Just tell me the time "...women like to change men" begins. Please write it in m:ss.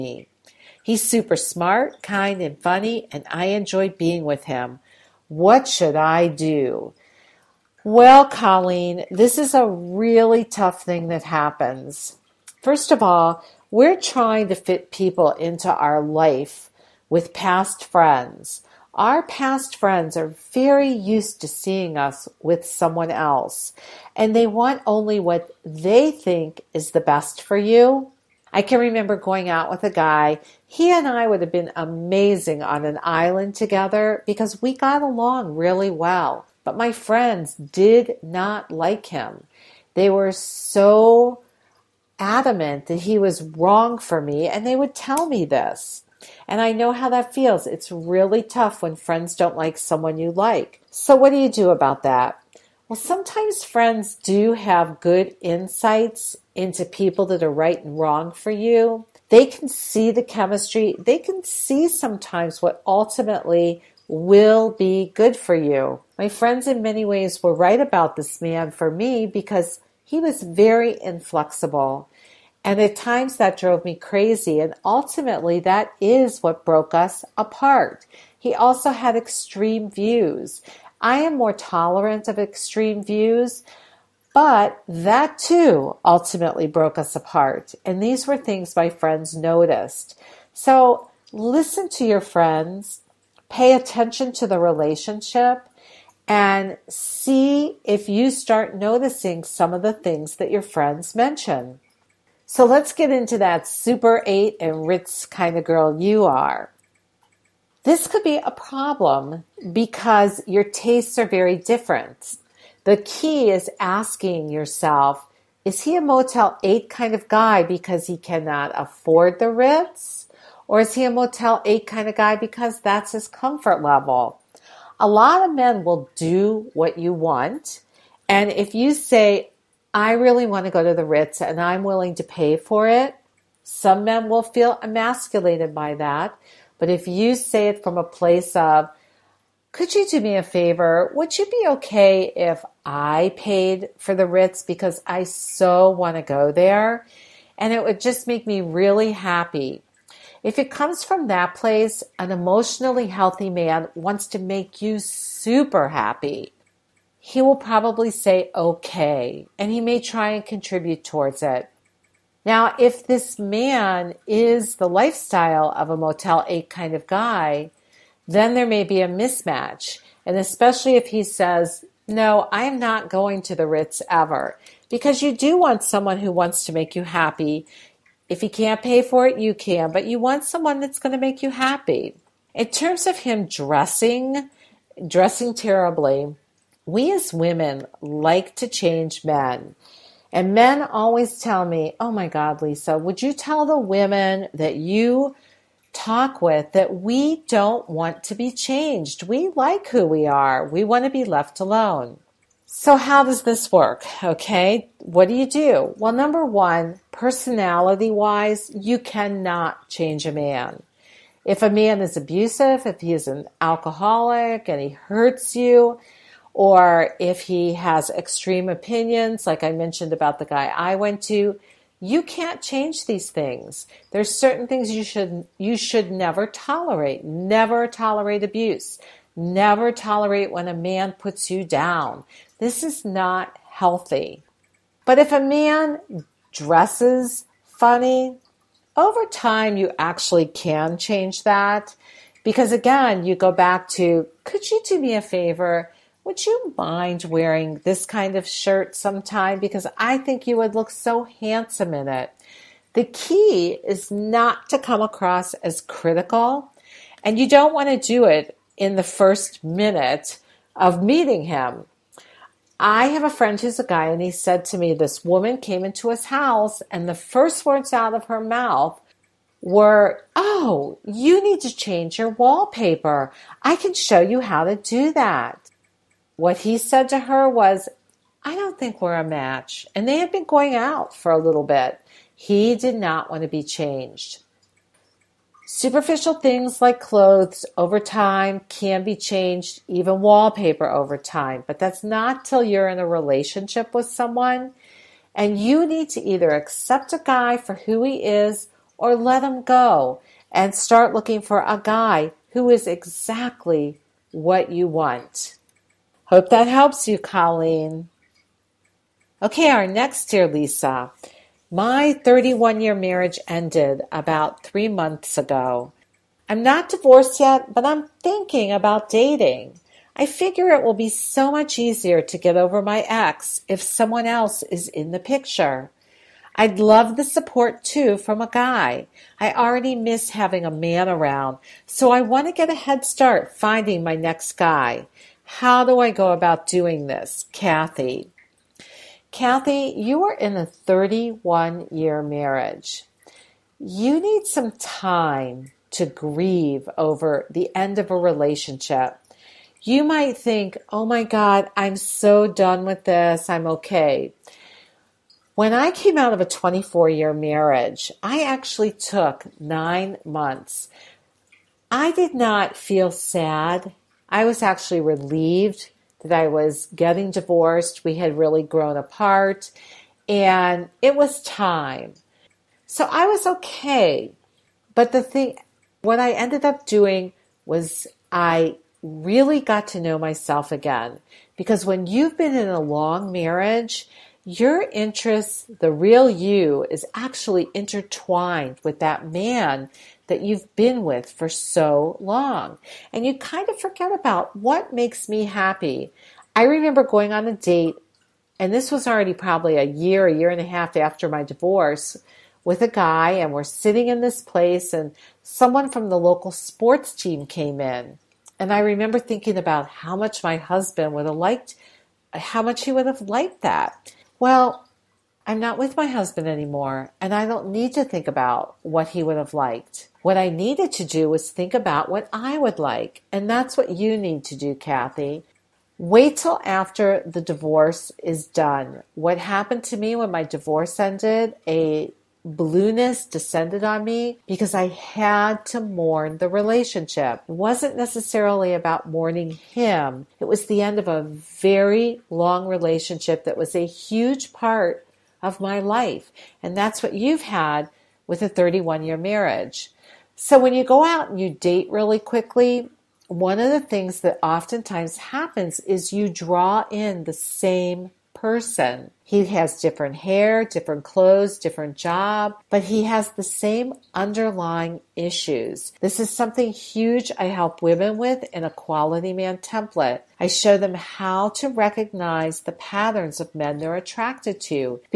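3:07.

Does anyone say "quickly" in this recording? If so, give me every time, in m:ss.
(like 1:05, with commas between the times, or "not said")
7:32.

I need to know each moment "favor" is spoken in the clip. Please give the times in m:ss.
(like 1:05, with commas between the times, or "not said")
2:20, 4:05.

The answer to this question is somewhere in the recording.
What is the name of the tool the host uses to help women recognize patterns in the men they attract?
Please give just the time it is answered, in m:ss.
7:48.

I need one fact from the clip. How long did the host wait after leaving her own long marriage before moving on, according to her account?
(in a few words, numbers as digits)
nine months.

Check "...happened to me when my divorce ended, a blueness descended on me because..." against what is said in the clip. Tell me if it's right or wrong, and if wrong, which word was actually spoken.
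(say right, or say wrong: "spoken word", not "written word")
right.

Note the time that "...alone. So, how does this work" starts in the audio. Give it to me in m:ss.
3:21.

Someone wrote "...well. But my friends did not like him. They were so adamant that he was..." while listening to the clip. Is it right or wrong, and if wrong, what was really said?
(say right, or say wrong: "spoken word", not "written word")
right.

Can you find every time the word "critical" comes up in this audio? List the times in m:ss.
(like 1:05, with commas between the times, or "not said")
4:15.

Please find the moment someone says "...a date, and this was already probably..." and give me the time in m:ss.
6:37.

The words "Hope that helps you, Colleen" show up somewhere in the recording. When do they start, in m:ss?
5:06.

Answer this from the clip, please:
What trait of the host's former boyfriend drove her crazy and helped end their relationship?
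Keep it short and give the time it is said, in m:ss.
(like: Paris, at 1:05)
inflexible, at 1:11.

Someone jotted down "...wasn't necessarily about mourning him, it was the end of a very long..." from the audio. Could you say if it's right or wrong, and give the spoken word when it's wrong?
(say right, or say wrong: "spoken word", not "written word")
right.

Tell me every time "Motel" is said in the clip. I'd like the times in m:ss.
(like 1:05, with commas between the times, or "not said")
1:56, 2:01, 2:45.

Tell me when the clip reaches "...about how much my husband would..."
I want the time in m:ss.
6:49.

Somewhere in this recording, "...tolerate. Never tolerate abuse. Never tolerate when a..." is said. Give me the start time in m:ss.
3:46.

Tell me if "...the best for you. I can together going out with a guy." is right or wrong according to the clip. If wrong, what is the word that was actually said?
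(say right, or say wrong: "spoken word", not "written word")
wrong: "remember", not "together".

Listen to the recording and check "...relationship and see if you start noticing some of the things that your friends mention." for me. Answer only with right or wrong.
right.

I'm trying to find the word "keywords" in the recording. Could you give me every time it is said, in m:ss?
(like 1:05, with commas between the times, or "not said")
not said.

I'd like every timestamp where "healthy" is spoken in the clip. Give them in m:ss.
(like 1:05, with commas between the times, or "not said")
2:33, 3:53.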